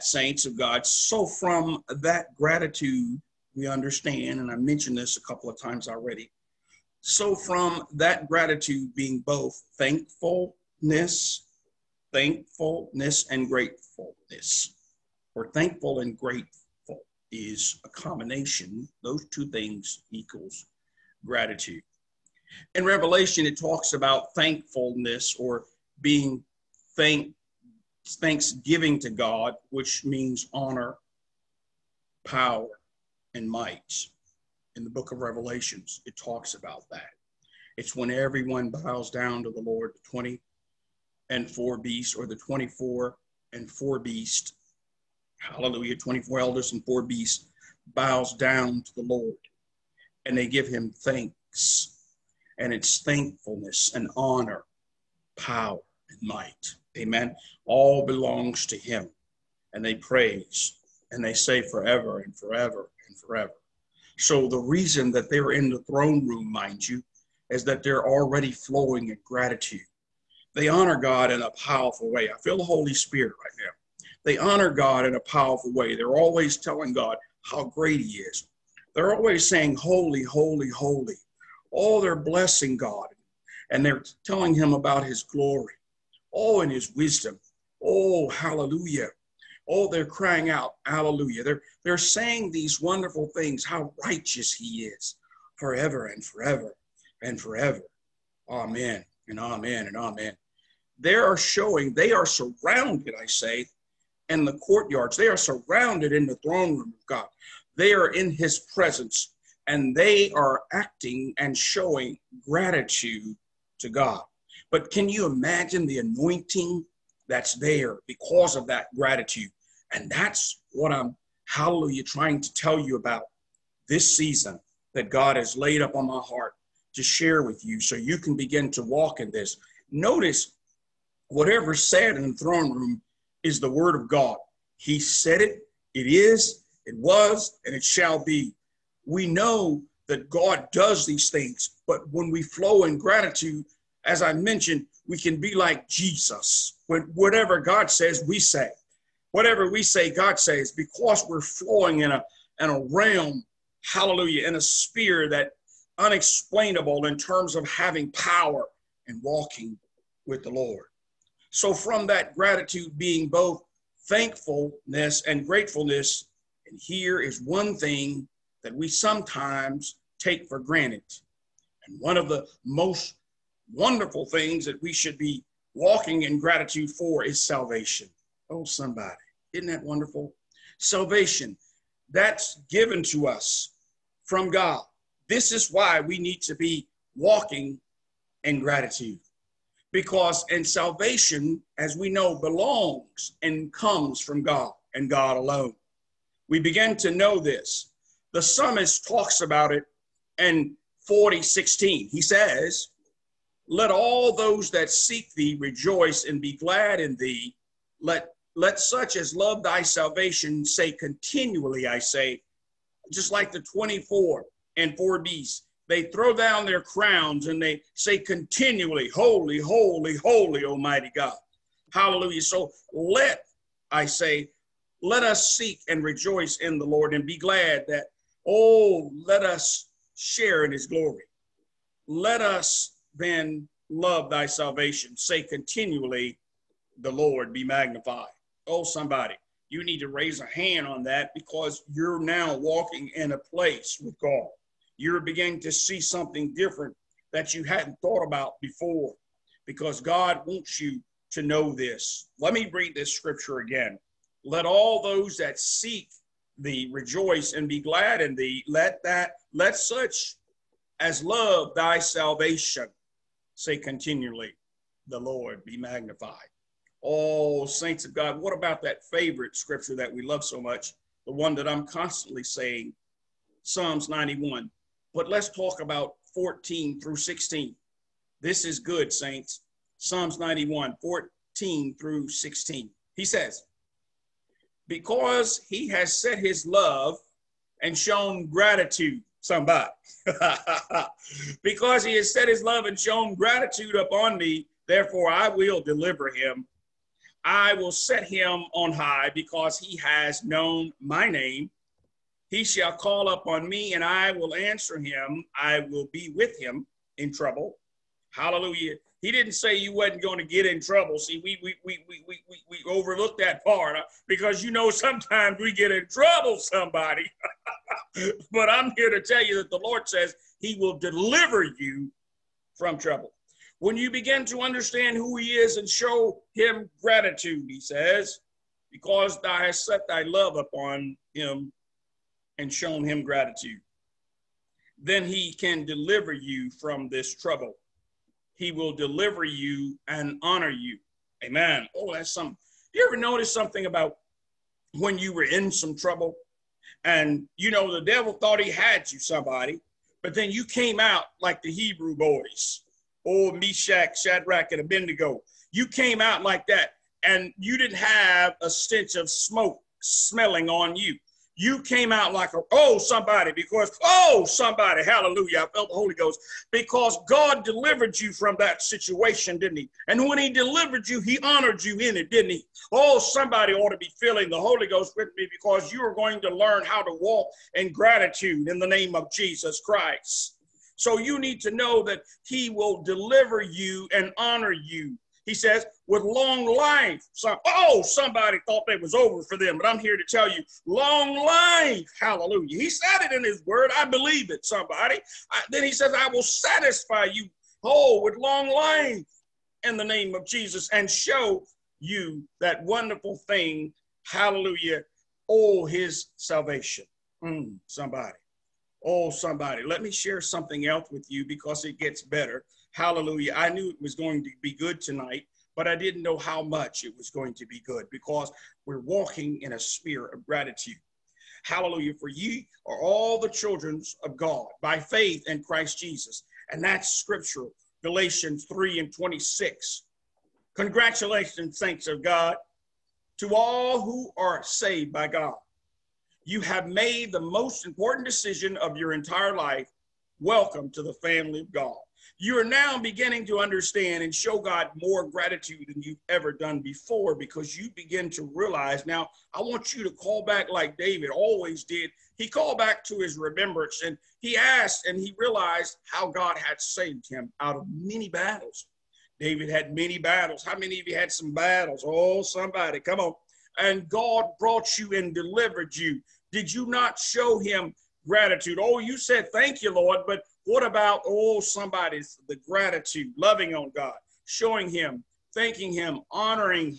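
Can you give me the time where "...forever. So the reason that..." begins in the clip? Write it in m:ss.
1:03.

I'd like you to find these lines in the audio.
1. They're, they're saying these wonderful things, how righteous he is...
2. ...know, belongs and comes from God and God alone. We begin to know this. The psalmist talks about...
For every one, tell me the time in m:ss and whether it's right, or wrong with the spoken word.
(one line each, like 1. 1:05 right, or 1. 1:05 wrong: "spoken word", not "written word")
1. 1:31 right
2. 3:12 right.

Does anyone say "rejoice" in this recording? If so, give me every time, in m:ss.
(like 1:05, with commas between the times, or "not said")
3:25, 3:46, 4:16.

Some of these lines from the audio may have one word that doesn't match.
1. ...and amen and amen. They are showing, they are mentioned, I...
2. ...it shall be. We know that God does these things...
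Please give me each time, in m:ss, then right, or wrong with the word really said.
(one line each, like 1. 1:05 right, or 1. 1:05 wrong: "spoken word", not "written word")
1. 1:39 wrong: "surrounded", not "mentioned"
2. 2:17 right.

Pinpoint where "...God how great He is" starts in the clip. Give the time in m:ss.
1:16.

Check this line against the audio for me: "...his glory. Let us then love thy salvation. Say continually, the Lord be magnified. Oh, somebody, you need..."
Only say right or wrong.
right.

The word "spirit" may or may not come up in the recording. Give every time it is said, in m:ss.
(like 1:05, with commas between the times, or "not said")
1:12, 6:59.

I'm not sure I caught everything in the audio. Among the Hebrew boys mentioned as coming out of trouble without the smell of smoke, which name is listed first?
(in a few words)
Meshach.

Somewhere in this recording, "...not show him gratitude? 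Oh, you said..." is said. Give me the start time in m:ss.
7:46.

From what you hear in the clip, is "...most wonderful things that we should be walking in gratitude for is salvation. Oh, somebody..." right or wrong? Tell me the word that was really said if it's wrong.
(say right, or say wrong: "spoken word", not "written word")
right.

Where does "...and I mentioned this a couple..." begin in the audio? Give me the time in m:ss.
0:04.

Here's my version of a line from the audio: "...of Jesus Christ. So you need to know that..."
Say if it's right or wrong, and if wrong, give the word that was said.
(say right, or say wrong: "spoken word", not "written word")
right.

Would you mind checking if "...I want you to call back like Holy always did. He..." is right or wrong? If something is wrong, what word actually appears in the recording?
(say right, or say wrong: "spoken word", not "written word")
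wrong: "David", not "Holy".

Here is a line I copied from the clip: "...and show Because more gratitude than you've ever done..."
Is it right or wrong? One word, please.
wrong.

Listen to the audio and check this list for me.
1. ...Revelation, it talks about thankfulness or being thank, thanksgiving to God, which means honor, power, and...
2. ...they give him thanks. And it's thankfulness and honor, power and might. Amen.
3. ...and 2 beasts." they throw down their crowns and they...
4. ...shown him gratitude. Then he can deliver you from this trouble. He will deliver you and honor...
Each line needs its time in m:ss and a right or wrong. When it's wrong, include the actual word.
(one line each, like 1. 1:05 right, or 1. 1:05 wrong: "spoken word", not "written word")
1. 0:22 right
2. 0:50 right
3. 3:34 wrong: "4", not "2"
4. 5:32 right.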